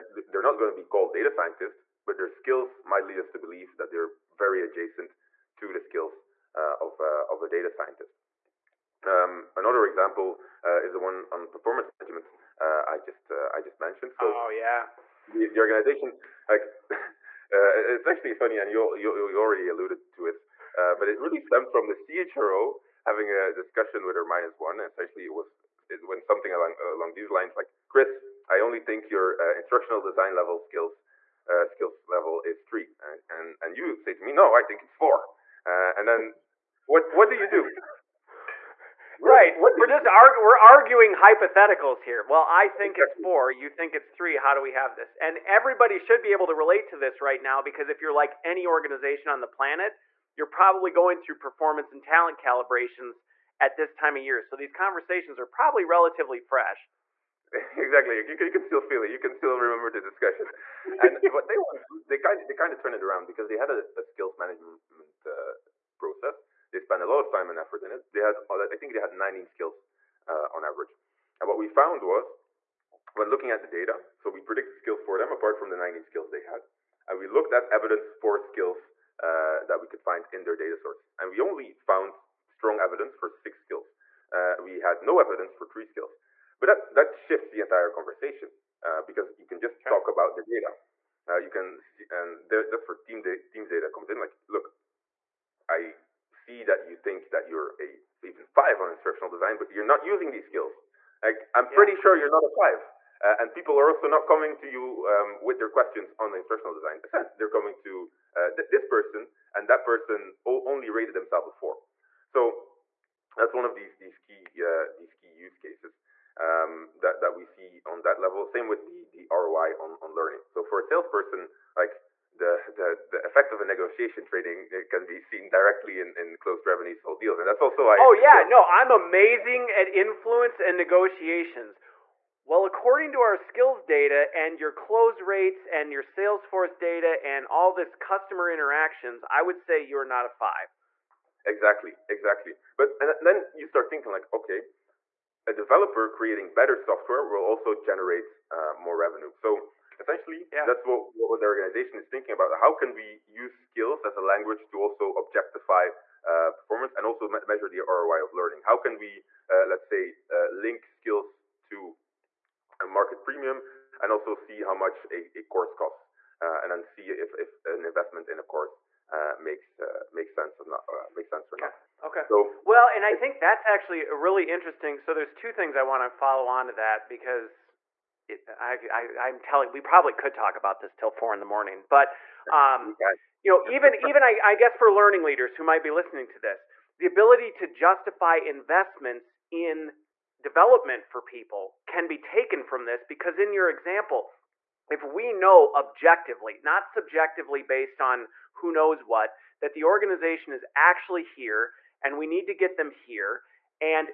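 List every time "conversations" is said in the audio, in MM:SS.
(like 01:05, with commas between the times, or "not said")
00:54, 01:27.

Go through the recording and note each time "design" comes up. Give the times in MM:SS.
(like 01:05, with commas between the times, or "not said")
00:30, 01:39, 01:46.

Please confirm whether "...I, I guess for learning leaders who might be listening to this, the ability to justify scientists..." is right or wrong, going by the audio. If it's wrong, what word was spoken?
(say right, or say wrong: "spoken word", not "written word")
wrong: "investments", not "scientists".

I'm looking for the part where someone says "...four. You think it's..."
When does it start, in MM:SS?
00:43.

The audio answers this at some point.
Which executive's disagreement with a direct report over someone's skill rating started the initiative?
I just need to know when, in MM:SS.
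00:21.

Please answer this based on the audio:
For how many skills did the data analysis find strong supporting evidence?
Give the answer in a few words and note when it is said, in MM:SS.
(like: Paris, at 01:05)
6, at 01:23.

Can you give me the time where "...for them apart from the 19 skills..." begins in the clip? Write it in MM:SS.
01:15.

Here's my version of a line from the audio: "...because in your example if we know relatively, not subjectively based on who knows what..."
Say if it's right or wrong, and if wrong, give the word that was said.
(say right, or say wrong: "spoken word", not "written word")
wrong: "objectively", not "relatively".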